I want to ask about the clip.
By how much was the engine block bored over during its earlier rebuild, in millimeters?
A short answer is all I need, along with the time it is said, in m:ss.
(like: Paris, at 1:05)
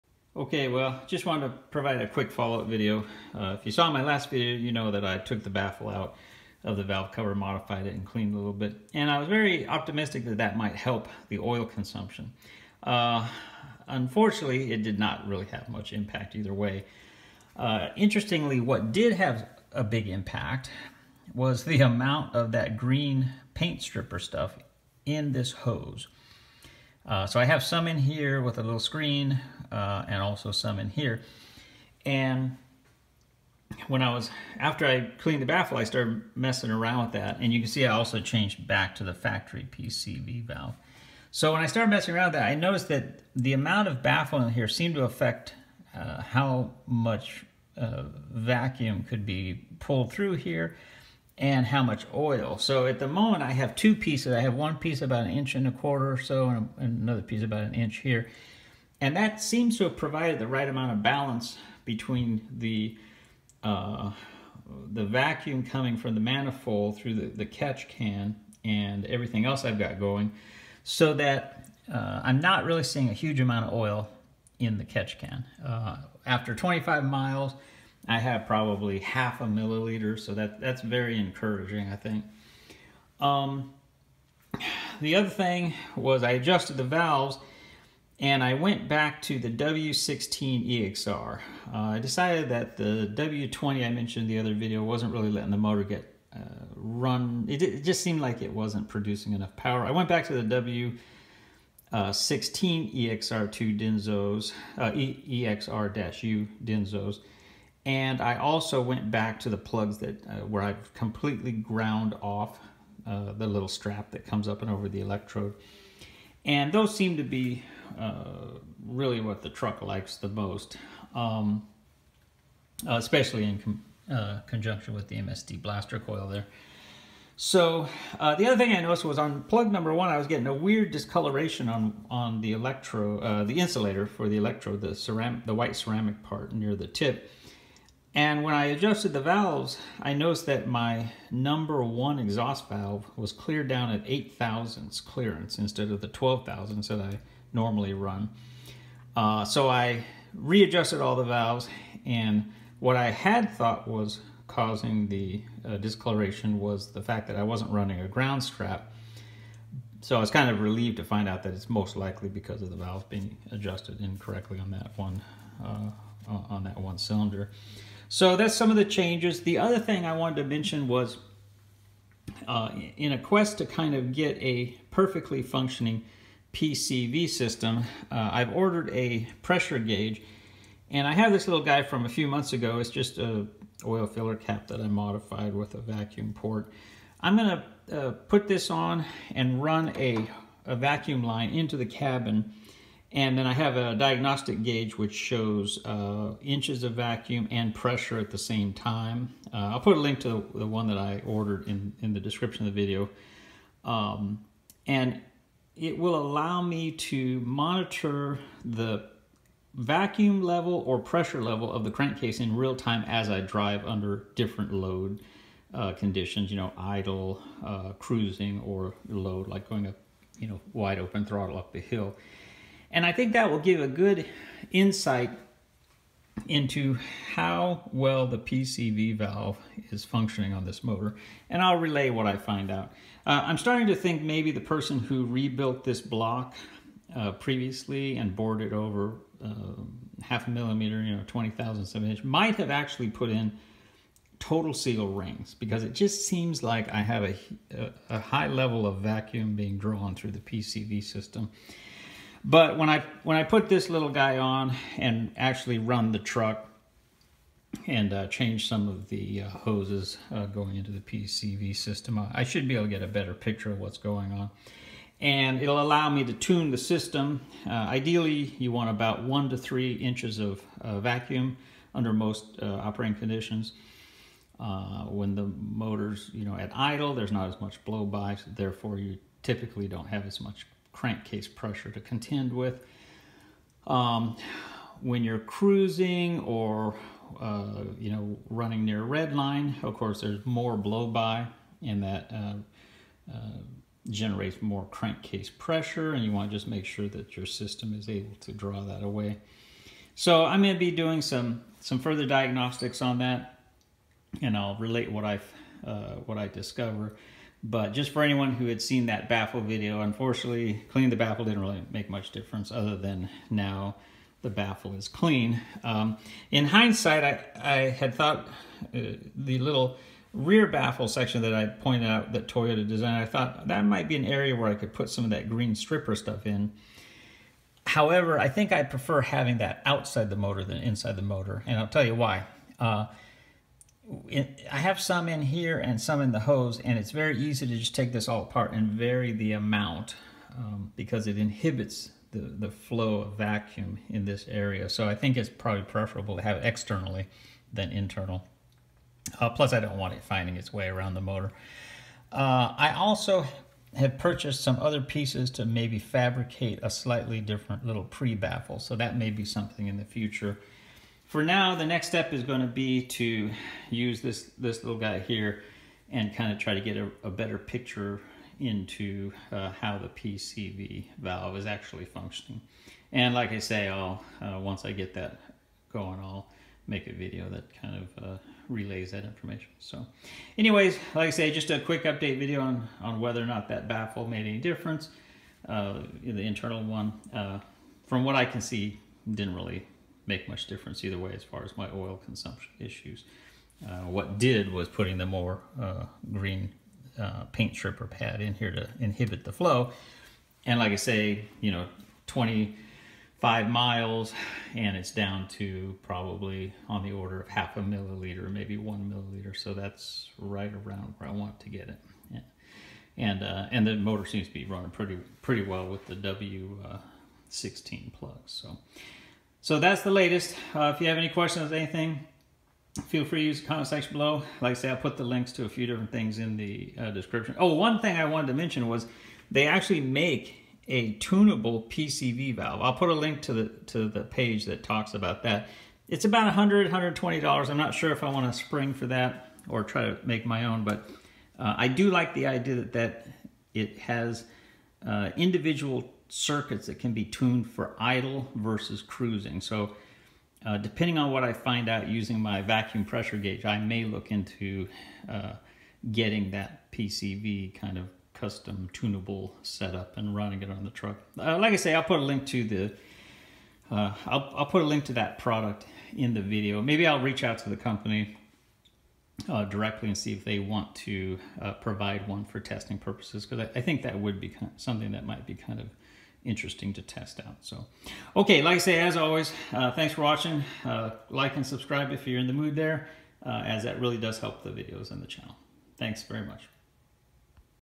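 half a millimeter, at 4:00.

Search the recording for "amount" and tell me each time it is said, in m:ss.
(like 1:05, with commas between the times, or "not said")
0:21, 0:43, 1:00, 1:13, 5:39.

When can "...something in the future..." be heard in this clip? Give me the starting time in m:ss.
5:59.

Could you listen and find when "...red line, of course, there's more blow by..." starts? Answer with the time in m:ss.
4:49.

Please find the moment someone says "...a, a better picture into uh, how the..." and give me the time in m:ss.
6:06.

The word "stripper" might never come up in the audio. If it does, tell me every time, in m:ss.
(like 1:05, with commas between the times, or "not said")
0:23, 5:25, 6:37.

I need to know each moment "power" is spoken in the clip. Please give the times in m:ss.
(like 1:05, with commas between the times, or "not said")
1:39.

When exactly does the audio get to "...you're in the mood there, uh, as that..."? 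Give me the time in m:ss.
8:02.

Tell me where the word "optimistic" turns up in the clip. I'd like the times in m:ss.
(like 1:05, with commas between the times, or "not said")
0:09.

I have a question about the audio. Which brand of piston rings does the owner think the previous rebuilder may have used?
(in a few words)
Total Seal.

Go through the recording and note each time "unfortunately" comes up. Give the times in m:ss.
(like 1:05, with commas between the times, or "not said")
0:13, 5:10.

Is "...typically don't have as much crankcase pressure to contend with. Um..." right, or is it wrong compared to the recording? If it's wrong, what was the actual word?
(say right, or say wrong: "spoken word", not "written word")
right.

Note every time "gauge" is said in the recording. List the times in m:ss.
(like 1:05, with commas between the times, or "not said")
2:59, 3:14, 7:33.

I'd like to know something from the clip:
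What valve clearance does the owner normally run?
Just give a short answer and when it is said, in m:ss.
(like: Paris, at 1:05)
12 thousandths, at 2:26.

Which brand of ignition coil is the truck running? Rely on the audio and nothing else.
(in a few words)
MSD Blaster.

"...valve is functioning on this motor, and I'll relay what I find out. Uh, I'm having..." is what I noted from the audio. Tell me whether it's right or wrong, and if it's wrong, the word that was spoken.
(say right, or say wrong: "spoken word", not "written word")
wrong: "starting", not "having".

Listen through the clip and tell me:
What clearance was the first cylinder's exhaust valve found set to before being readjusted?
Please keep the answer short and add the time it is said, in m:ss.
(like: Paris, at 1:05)
8 thousandths, at 2:24.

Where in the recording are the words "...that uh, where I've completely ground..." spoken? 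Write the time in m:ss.
1:49.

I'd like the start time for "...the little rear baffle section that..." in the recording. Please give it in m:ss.
5:19.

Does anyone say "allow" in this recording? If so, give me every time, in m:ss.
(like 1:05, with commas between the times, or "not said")
3:26, 4:25.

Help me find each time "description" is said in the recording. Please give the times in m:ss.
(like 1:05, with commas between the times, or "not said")
3:22, 7:07.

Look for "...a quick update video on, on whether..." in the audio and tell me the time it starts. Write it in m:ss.
6:21.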